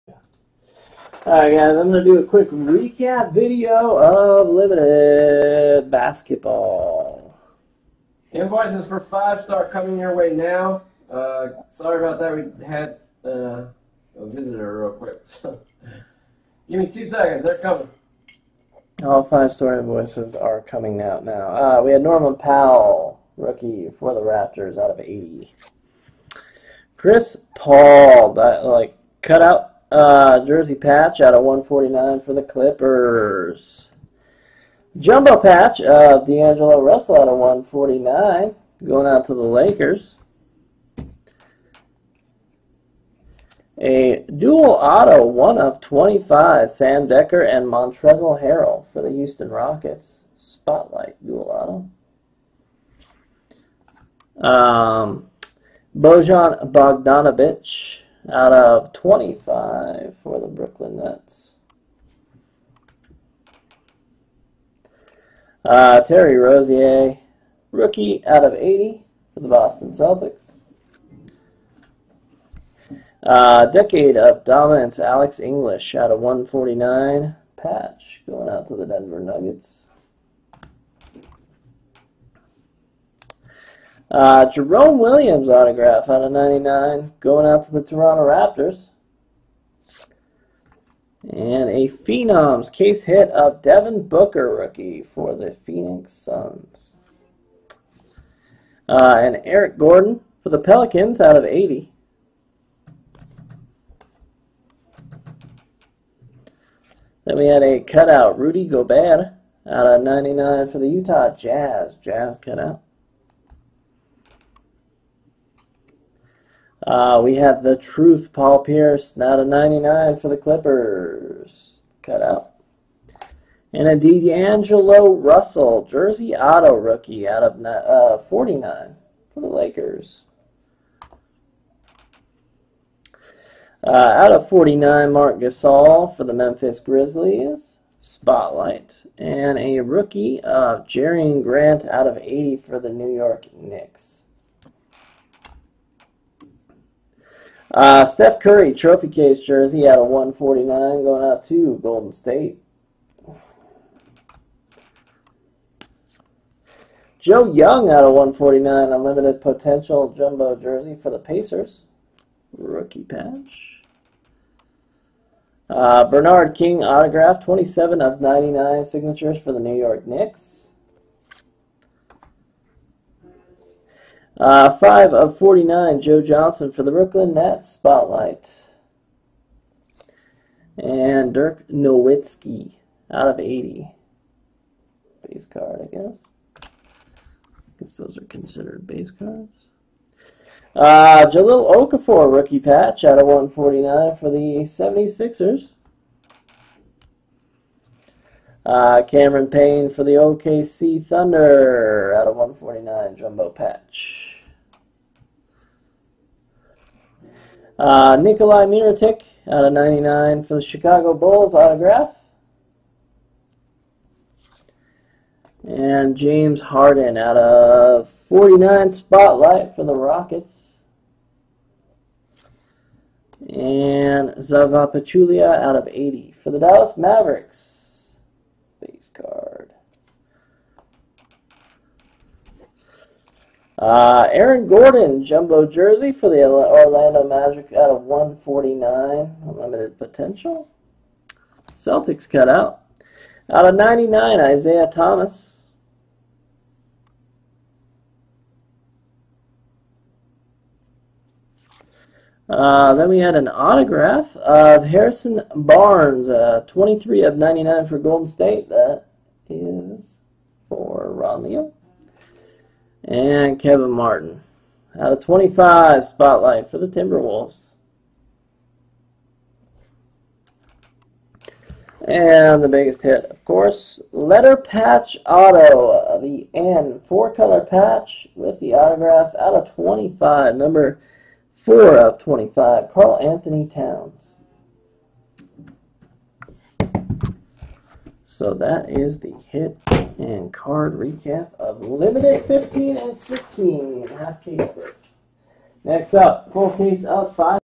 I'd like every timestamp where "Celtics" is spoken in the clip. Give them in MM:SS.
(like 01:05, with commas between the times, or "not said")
01:09, 04:01.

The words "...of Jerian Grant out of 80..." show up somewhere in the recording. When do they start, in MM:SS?
02:20.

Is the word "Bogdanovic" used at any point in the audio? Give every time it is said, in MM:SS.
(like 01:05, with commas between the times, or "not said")
00:56.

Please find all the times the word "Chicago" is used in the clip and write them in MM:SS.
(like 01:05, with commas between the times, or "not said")
03:30.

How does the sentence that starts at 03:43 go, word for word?
And Zaza Pachulia out of 80 for the Dallas Mavericks.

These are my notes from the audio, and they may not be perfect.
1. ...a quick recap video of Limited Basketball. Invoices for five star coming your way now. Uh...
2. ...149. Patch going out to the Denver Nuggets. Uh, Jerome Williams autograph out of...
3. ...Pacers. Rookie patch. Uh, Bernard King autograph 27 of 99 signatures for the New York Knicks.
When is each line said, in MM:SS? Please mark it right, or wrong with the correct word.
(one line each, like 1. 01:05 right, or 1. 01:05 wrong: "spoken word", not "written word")
1. 00:02 right
2. 01:16 right
3. 02:41 right.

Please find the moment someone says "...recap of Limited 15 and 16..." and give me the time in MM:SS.
04:50.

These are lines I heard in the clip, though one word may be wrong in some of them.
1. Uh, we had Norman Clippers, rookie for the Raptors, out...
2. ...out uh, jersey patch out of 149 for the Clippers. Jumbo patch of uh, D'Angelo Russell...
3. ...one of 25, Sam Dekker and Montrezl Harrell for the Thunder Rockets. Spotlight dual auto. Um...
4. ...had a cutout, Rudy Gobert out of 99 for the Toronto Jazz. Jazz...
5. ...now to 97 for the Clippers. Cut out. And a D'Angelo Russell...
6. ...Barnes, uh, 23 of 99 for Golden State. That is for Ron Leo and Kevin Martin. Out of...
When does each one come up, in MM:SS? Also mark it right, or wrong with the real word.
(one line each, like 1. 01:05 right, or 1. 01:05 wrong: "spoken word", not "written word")
1. 00:21 wrong: "Powell", not "Clippers"
2. 00:29 right
3. 00:45 wrong: "Houston", not "Thunder"
4. 01:47 wrong: "Utah", not "Toronto"
5. 01:59 wrong: "99", not "97"
6. 04:15 right.